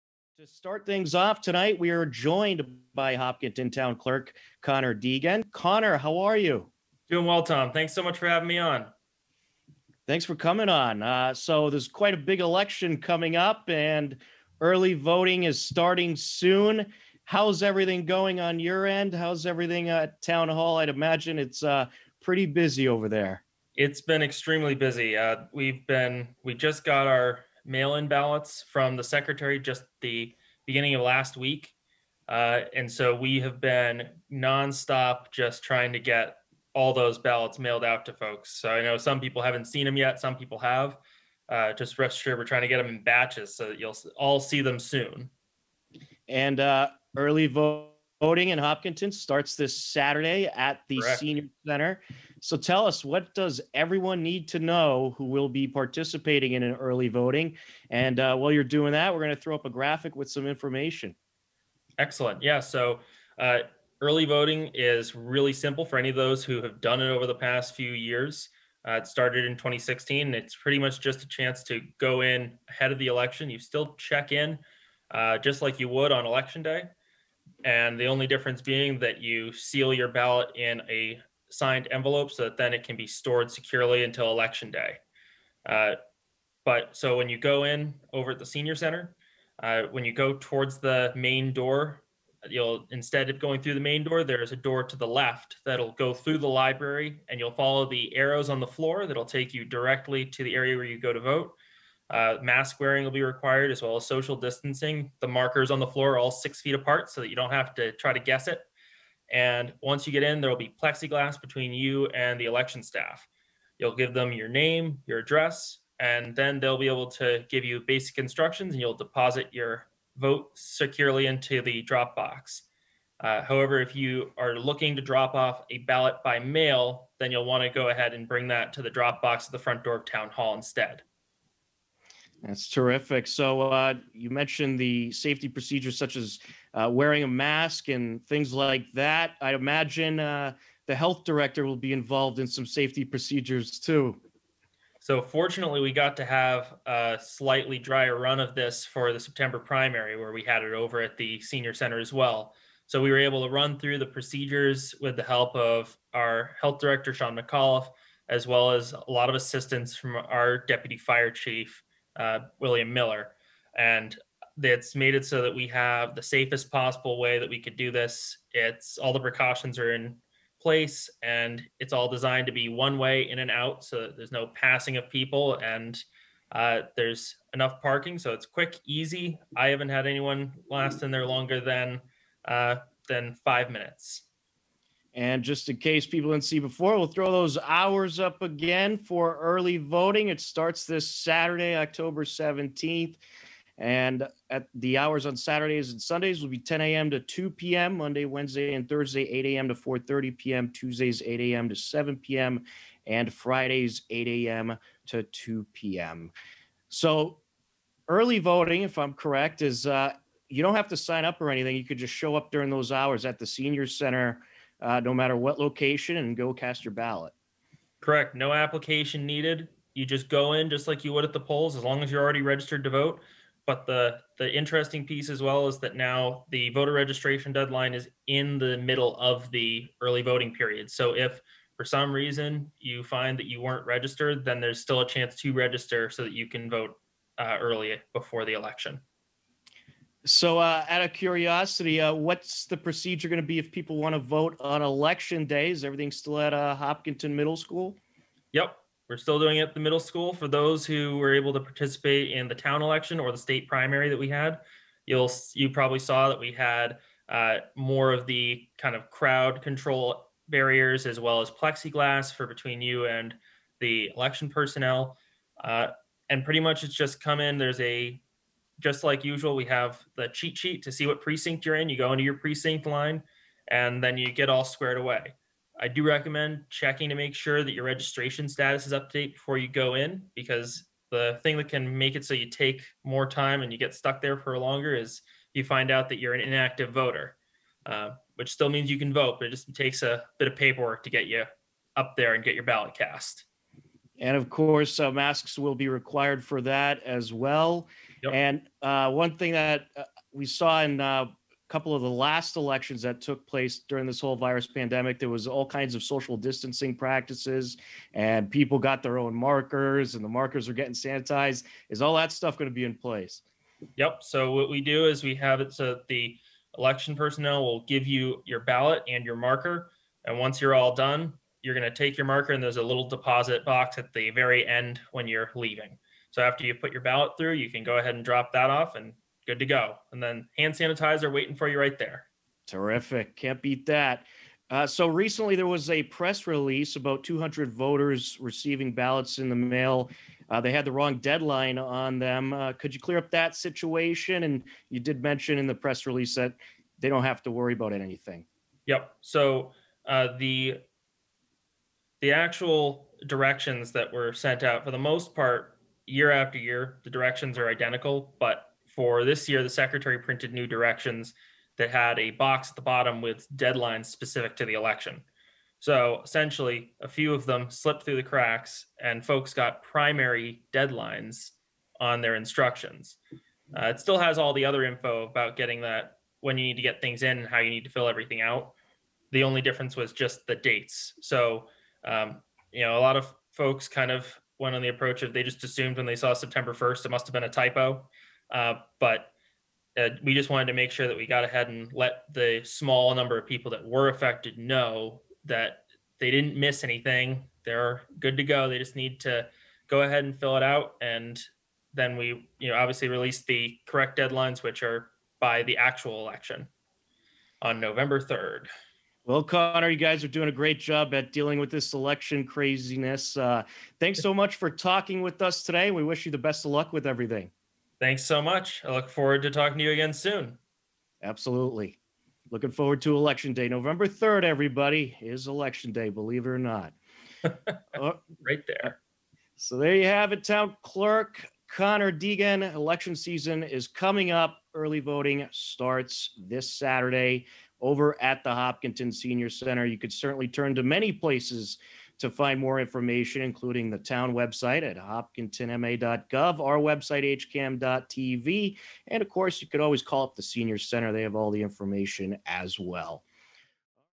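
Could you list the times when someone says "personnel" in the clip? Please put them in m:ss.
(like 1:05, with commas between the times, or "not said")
4:24, 5:17.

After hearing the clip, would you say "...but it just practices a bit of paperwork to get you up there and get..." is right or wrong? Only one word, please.
wrong.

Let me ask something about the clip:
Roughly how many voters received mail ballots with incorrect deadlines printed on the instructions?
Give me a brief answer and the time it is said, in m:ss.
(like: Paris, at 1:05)
200, at 5:37.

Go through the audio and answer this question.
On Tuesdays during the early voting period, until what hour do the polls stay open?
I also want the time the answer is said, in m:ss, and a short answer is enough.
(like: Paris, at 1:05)
7 p.m., at 3:21.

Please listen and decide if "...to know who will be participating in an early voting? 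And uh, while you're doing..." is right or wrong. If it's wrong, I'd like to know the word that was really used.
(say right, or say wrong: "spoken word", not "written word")
right.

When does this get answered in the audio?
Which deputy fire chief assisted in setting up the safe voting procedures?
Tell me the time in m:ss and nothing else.
2:42.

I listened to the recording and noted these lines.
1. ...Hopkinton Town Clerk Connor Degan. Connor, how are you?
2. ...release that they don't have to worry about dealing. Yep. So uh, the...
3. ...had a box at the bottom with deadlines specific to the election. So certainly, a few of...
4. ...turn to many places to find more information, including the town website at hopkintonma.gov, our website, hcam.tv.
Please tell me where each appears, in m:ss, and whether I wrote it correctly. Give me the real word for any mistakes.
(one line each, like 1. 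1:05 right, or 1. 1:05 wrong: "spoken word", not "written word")
1. 0:03 right
2. 5:46 wrong: "anything", not "dealing"
3. 6:01 wrong: "essentially", not "certainly"
4. 7:20 right.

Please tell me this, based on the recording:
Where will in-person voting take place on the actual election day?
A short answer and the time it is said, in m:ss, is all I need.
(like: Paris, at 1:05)
Hopkinton Middle School, at 4:06.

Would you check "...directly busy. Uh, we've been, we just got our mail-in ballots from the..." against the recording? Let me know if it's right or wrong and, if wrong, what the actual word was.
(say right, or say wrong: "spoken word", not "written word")
wrong: "extremely", not "directly".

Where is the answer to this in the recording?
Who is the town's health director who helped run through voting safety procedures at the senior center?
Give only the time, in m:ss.
2:37.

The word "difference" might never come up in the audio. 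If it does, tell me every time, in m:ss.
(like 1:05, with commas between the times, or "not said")
1:18, 6:19.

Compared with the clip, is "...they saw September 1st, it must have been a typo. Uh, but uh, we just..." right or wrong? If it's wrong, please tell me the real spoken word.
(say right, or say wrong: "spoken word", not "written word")
right.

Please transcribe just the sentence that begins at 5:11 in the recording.
Is all that stuff going to be in place?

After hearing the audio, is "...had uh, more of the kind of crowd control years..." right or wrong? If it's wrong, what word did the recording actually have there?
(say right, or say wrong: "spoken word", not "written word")
wrong: "barriers", not "years".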